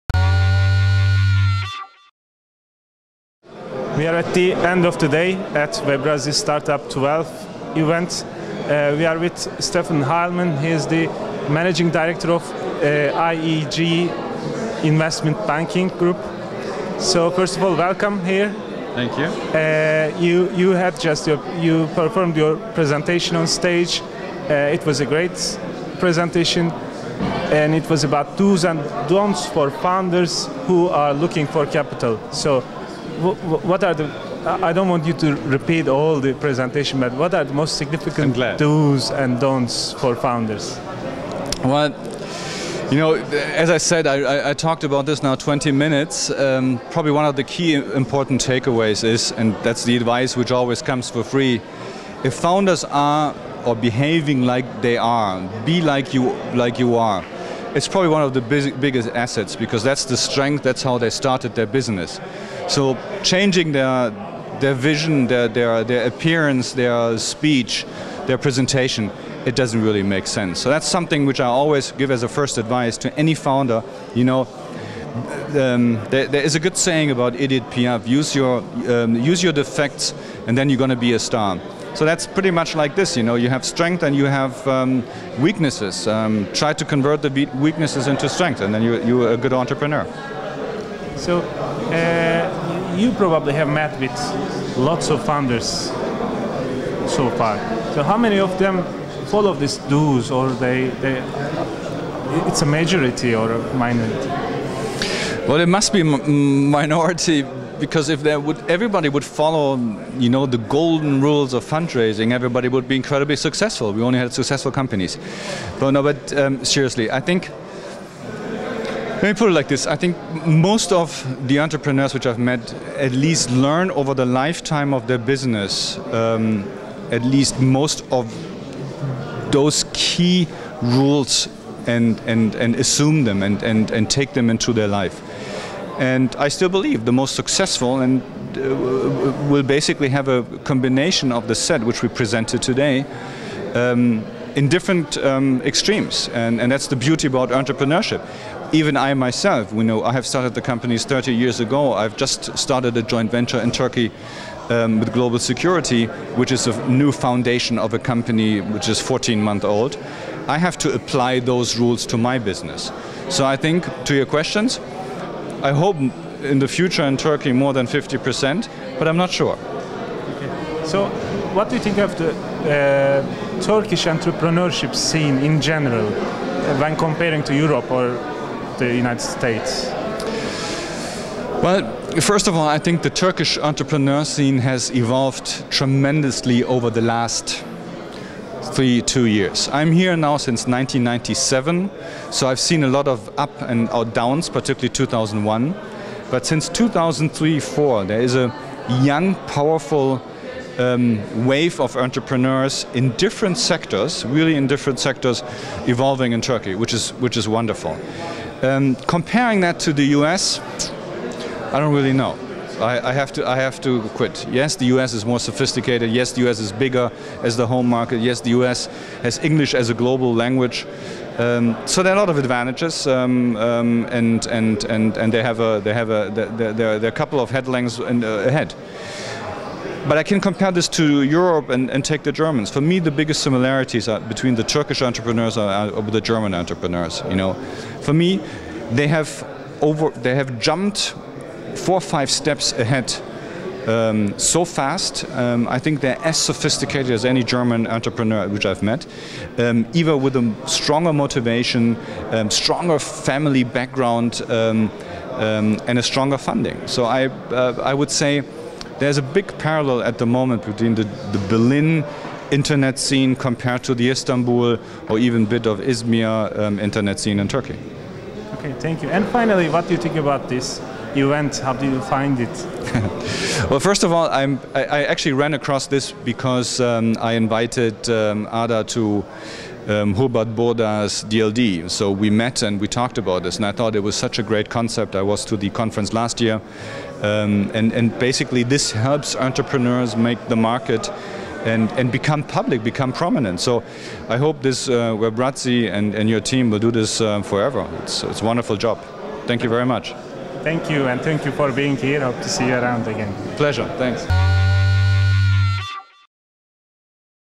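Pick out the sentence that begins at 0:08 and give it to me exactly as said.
Uh, we are with Stefan Heilmann.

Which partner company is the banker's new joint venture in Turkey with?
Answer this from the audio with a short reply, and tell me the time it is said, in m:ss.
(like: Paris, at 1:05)
Global Security, at 2:35.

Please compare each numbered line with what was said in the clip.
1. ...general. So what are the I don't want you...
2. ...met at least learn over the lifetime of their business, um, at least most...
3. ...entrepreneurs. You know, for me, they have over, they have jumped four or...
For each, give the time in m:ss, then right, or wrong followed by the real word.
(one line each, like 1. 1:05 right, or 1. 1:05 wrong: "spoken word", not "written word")
1. 0:31 wrong: "capital", not "general"
2. 2:02 right
3. 3:56 right.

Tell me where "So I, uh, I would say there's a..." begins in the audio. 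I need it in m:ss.
4:16.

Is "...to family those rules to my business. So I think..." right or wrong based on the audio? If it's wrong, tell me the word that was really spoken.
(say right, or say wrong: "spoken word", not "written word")
wrong: "apply", not "family".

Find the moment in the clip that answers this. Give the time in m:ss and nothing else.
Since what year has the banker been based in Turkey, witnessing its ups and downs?
3:10.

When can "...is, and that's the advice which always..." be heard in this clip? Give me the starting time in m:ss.
0:49.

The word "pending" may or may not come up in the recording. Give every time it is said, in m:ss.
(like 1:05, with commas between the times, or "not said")
not said.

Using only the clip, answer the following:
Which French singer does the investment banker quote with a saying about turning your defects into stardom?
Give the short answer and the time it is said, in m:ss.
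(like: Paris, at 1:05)
Edith Piaf, at 1:17.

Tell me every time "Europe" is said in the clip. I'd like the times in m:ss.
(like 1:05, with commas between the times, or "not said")
2:57, 3:51.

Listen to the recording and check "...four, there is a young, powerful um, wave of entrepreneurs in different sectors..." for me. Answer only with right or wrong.
right.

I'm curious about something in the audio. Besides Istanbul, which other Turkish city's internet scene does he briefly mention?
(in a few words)
Izmir.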